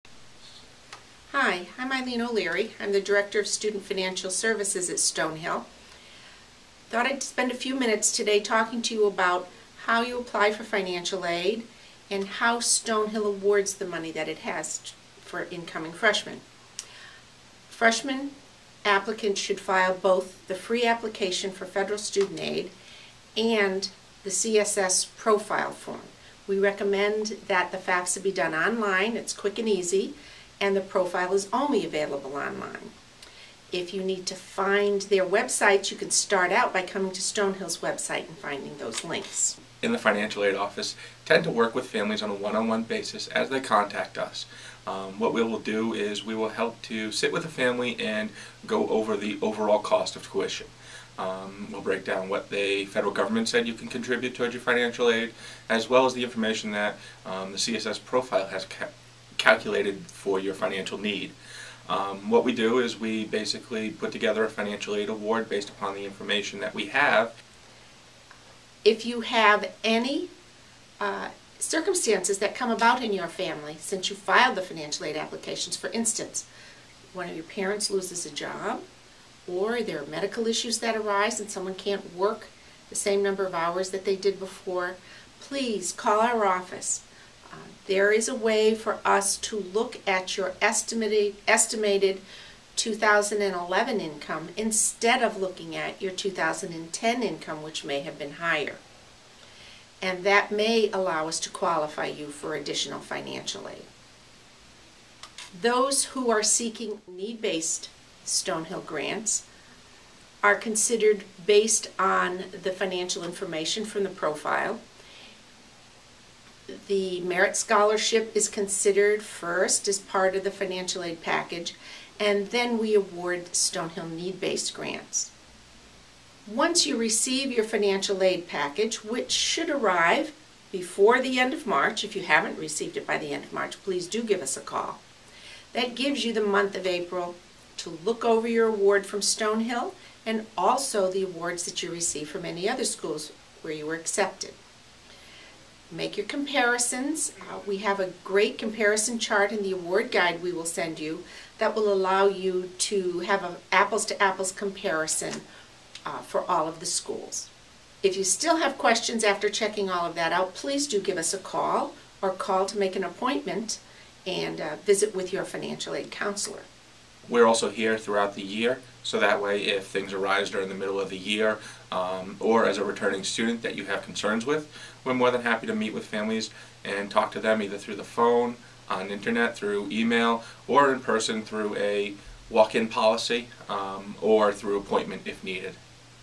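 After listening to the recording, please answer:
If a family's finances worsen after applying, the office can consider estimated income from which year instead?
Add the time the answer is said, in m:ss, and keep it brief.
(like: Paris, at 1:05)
2011, at 1:32.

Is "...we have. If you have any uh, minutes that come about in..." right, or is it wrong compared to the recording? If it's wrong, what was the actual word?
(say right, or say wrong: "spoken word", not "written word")
wrong: "circumstances", not "minutes".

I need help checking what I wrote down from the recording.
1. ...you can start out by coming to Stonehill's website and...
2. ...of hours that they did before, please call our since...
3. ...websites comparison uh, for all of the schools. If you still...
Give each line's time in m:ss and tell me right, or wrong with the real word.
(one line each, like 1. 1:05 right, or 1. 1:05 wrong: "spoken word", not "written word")
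1. 0:35 right
2. 1:23 wrong: "office", not "since"
3. 2:34 wrong: "apples", not "websites".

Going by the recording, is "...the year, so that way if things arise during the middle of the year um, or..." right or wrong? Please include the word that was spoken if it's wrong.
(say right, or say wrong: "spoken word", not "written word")
right.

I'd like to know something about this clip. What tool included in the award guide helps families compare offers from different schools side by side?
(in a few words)
comparison chart.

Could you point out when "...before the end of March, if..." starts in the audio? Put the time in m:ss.
2:10.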